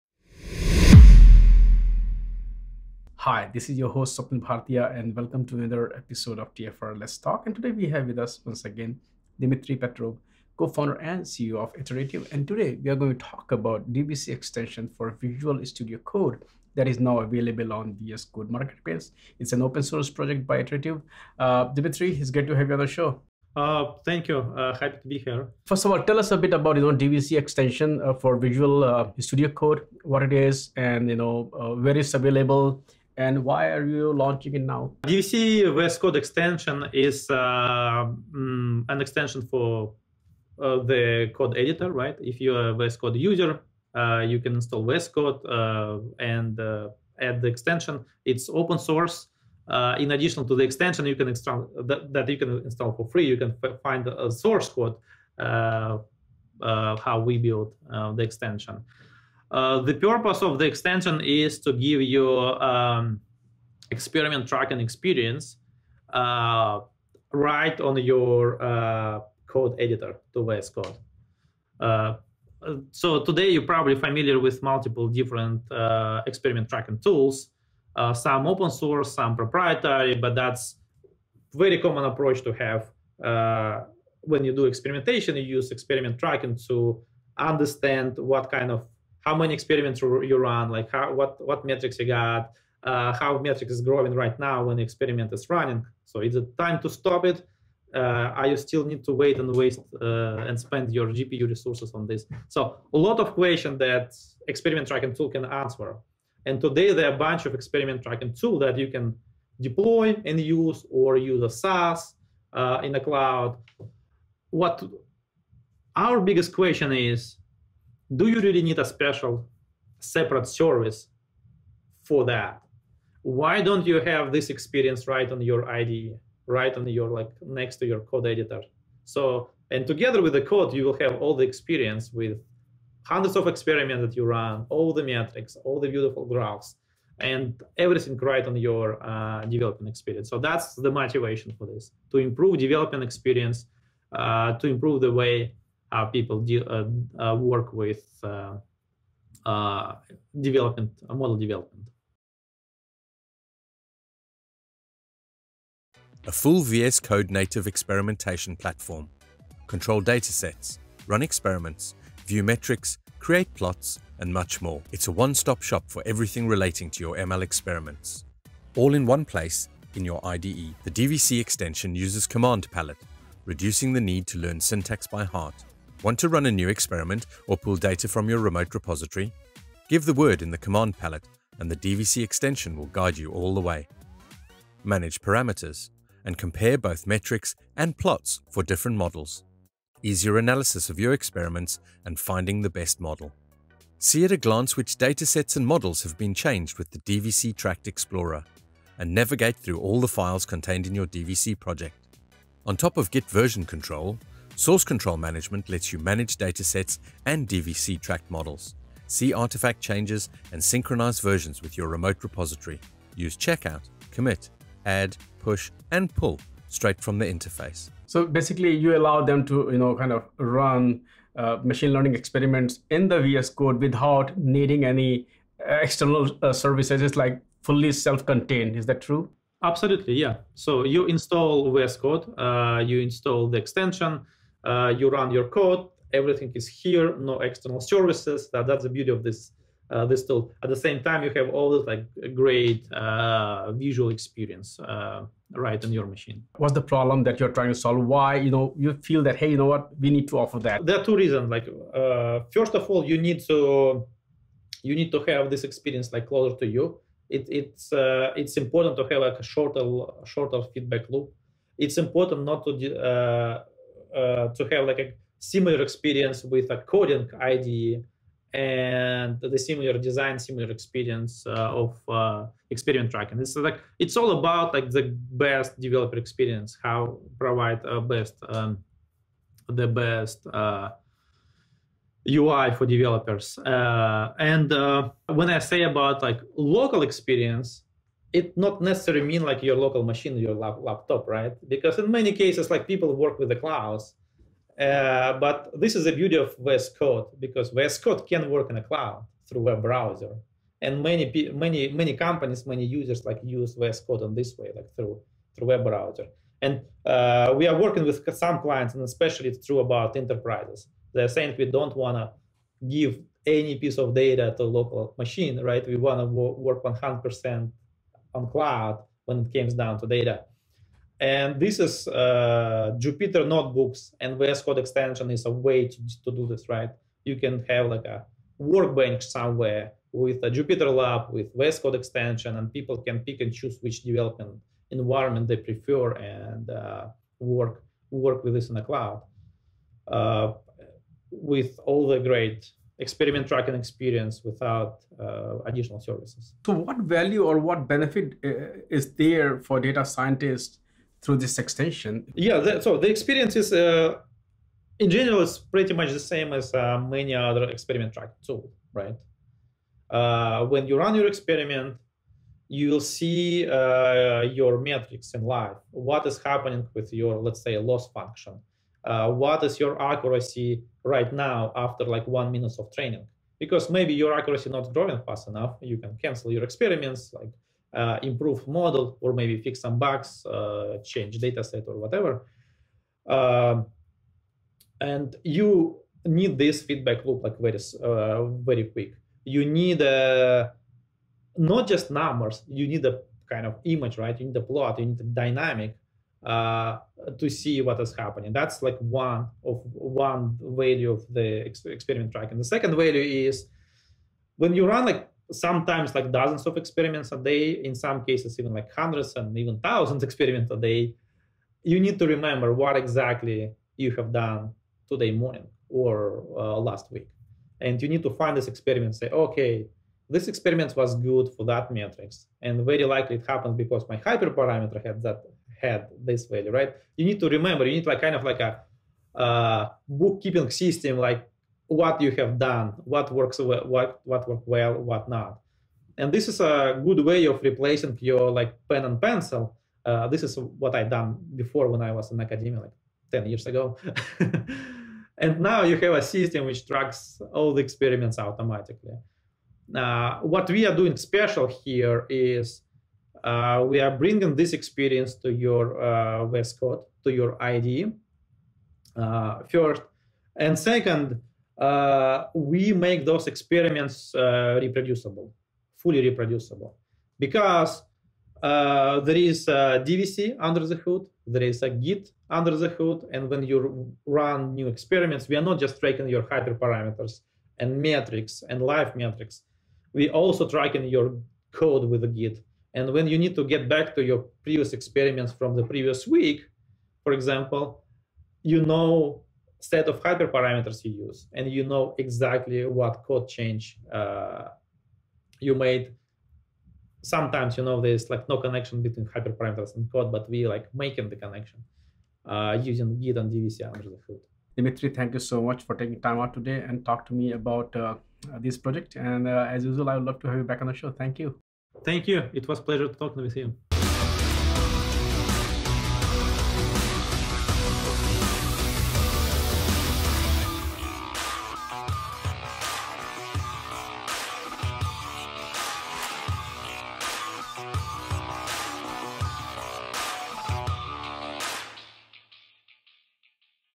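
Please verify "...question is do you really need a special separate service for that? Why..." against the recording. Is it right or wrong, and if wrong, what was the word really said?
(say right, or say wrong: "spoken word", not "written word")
right.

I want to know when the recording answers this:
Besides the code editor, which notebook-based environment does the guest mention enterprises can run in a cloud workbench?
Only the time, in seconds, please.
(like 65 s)
330 s.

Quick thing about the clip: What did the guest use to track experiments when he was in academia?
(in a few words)
pen and pencil.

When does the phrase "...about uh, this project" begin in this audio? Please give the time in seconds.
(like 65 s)
507 s.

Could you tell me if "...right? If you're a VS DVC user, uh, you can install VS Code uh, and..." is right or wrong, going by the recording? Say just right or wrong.
wrong.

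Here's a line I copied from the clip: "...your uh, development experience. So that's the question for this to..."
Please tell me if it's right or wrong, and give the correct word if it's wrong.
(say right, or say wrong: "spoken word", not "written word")
wrong: "motivation", not "question".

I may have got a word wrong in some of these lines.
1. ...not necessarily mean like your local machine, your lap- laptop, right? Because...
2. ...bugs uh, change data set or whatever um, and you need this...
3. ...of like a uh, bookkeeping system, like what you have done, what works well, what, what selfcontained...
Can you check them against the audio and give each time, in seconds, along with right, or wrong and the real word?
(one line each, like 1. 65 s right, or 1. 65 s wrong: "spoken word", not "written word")
1. 288 s right
2. 379 s right
3. 428 s wrong: "worked", not "selfcontained".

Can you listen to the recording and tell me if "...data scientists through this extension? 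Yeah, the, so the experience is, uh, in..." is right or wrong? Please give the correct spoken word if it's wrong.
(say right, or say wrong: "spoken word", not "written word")
right.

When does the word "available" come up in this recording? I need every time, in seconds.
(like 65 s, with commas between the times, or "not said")
17 s, 32 s.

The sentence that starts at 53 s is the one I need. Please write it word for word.
You can find a source code how we build the extension.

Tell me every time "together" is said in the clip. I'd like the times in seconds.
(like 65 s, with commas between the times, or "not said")
129 s.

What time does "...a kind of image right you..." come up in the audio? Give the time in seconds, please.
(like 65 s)
393 s.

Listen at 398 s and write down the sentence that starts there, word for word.
That's like one of one value of the ex- experiment tracking.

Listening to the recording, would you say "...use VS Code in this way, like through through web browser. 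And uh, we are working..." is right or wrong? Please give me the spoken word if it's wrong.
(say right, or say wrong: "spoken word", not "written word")
right.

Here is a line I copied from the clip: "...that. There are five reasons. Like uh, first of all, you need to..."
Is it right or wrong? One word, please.
wrong.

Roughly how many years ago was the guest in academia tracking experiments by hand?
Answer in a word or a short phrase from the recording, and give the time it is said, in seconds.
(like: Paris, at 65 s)
10 years, at 443 s.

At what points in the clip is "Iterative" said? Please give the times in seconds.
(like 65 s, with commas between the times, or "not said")
11 s, 20 s.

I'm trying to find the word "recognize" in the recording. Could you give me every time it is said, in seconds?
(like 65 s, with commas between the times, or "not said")
not said.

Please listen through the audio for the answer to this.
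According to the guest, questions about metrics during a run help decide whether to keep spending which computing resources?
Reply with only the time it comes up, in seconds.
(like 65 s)
101 s.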